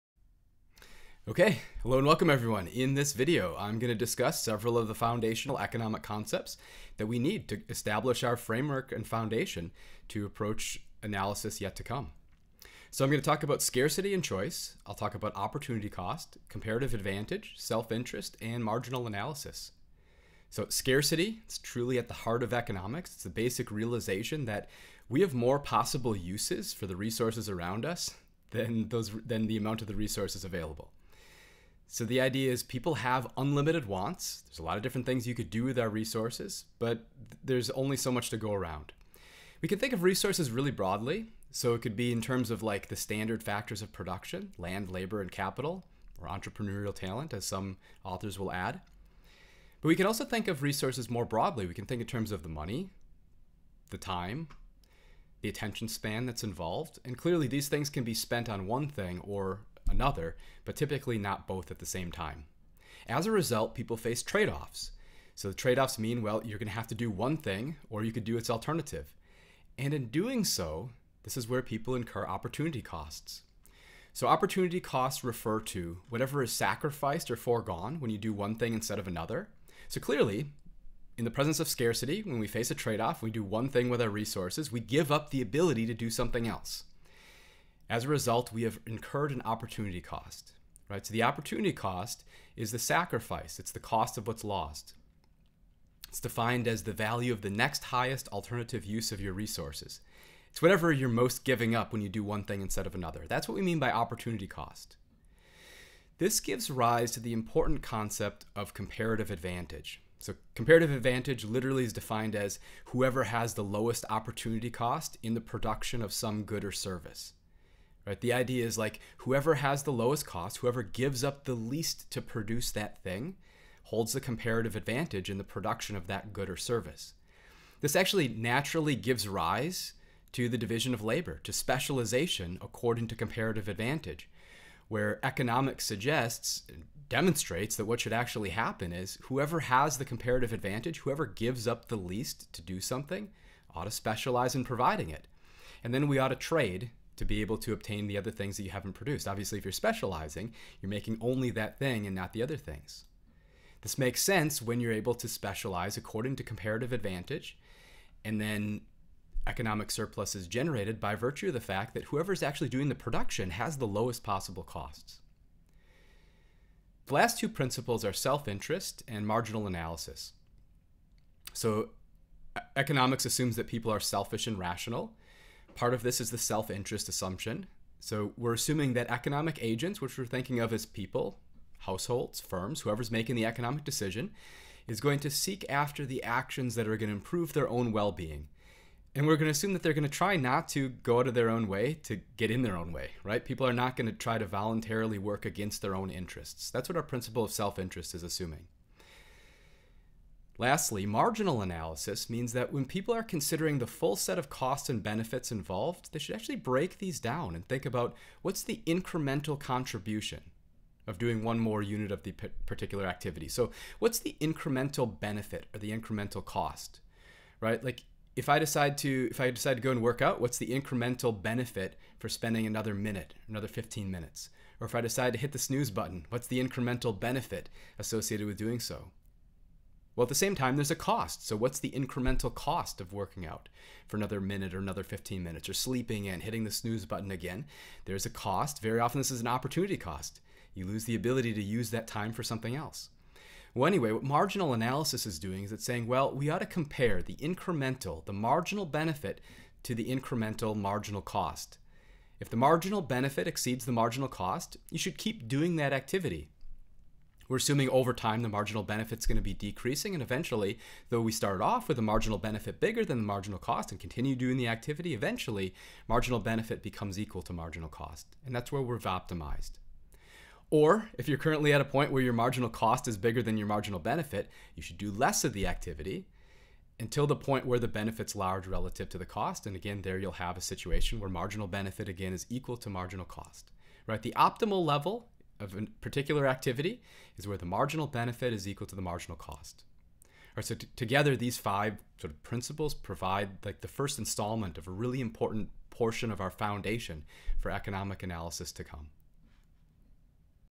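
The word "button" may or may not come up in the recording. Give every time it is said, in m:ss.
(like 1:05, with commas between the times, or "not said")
3:45, 3:57.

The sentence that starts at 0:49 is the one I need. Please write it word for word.
But we can also think of resources more broadly.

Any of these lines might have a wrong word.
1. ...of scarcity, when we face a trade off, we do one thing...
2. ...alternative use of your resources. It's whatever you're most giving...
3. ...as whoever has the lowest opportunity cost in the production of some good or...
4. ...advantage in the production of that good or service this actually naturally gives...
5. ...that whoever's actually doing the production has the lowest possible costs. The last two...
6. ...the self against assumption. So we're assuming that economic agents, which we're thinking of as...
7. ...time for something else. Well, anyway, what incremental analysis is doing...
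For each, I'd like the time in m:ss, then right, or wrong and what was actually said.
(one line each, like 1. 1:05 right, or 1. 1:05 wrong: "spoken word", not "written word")
1. 1:21 right
2. 1:38 right
3. 1:52 right
4. 2:04 right
5. 2:41 right
6. 2:56 wrong: "interest", not "against"
7. 4:02 wrong: "marginal", not "incremental".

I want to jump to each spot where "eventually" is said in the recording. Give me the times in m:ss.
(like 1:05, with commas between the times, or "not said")
4:20, 4:25.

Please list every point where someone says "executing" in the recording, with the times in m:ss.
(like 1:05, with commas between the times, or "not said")
not said.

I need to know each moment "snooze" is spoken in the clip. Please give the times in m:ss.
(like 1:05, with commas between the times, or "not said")
3:45, 3:56.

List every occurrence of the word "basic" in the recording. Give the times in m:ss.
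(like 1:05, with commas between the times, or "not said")
0:23.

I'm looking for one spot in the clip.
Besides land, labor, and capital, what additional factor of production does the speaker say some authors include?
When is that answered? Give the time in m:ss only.
0:46.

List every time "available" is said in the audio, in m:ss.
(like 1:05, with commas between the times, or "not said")
0:30.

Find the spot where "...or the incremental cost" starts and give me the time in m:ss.
3:35.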